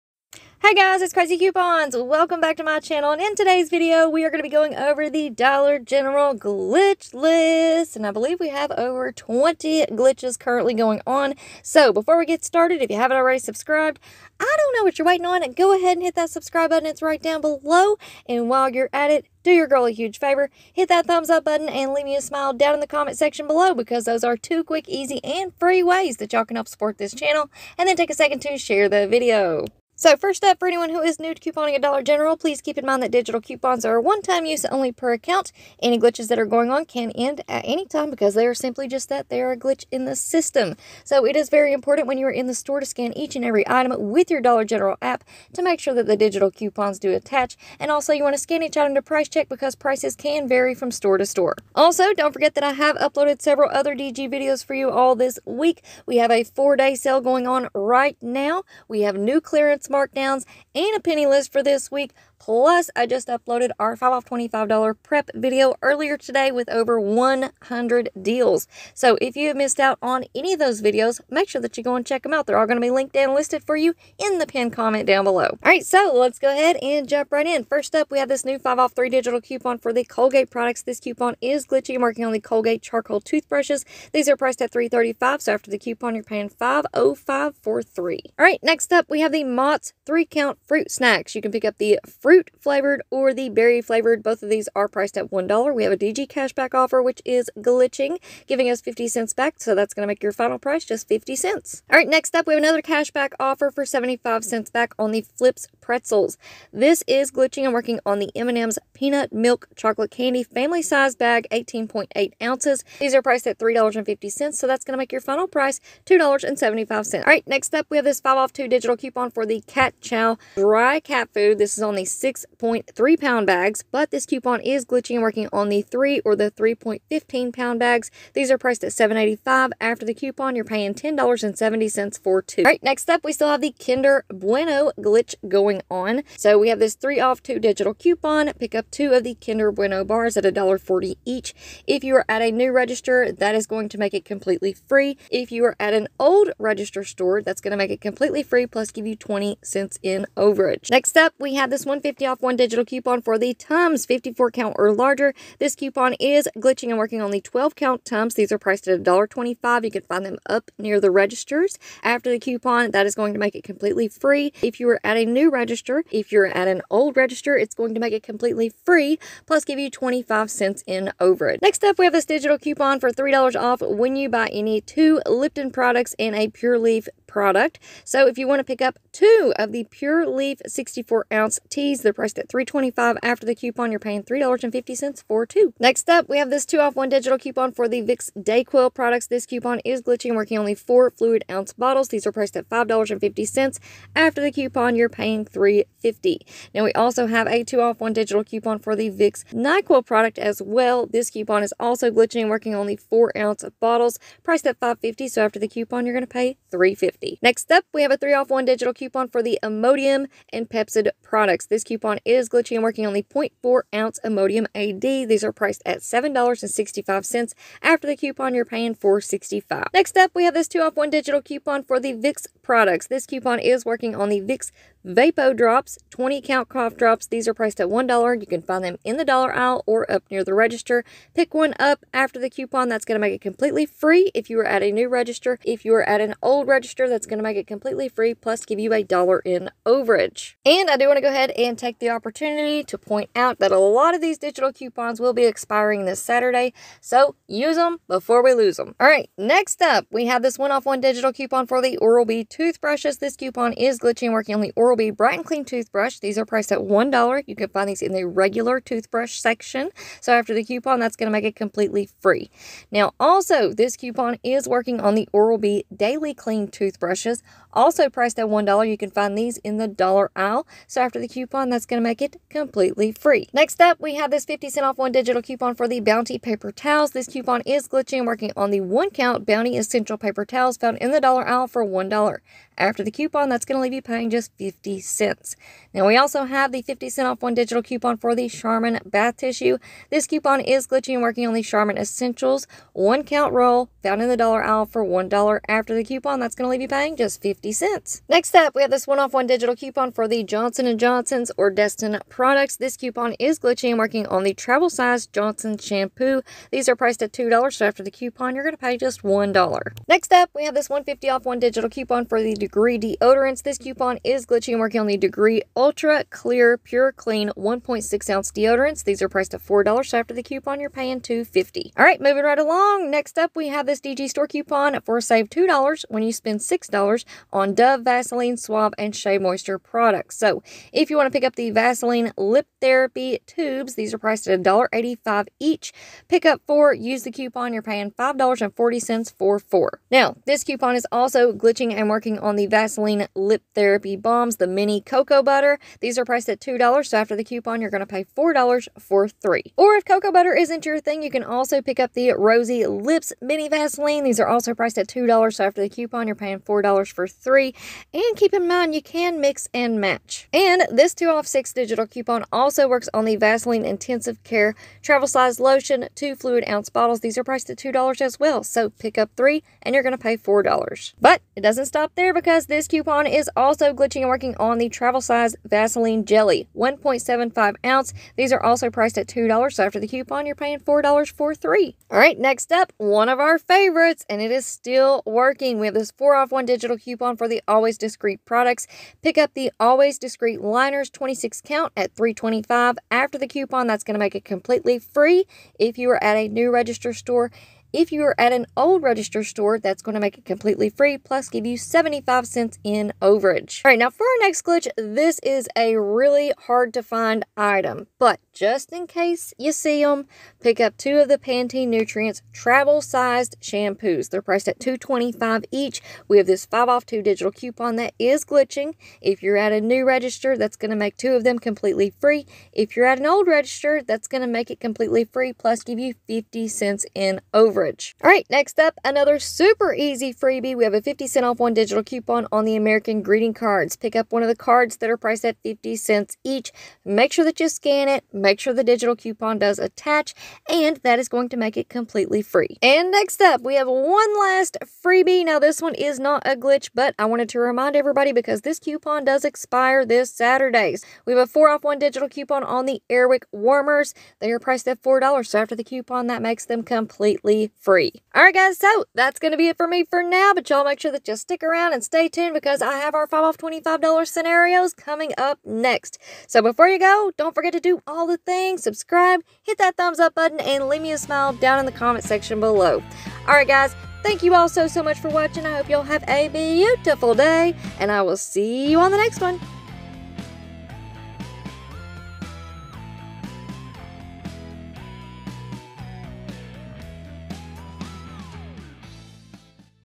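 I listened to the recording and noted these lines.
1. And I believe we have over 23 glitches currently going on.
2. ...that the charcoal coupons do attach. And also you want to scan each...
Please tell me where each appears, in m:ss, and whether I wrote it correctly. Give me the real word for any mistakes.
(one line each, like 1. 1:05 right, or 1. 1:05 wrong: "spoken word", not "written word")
1. 0:07 wrong: "20", not "23"
2. 0:45 wrong: "digital", not "charcoal".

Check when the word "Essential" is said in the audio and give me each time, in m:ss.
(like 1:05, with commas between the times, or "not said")
4:39, 4:51.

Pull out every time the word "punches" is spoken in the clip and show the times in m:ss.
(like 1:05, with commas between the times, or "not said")
not said.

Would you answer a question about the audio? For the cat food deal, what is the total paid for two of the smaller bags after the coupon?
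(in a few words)
$10.70.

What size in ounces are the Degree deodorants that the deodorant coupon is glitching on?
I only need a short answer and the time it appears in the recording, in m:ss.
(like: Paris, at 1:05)
1.6 ounce, at 5:17.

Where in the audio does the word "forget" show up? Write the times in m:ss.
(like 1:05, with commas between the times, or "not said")
0:52, 7:47.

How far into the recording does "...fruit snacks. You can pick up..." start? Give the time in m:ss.
1:30.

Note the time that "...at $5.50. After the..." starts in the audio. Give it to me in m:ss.
3:12.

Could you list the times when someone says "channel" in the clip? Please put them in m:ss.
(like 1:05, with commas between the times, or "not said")
0:02, 0:27.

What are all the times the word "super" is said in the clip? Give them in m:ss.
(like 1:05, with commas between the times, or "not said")
7:09.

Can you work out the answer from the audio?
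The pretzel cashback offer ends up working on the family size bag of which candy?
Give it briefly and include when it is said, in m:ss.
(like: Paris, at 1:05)
M&M's peanut, at 1:48.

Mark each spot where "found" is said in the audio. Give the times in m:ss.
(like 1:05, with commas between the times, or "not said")
4:40, 4:54.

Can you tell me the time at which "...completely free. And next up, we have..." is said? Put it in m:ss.
7:21.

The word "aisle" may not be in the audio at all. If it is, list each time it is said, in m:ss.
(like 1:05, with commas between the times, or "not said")
3:49, 4:30, 4:41, 4:54.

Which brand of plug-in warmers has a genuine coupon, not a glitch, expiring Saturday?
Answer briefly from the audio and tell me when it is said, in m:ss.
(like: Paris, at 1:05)
Airwick, at 7:33.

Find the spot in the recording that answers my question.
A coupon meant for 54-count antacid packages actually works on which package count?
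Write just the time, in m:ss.
2:37.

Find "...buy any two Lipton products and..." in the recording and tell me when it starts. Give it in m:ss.
2:54.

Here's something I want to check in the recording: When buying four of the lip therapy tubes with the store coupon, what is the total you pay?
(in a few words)
$5.40.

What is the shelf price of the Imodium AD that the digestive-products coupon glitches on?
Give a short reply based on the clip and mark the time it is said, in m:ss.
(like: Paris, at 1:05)
$7.65, at 3:35.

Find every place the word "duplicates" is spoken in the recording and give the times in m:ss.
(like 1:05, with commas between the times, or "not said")
not said.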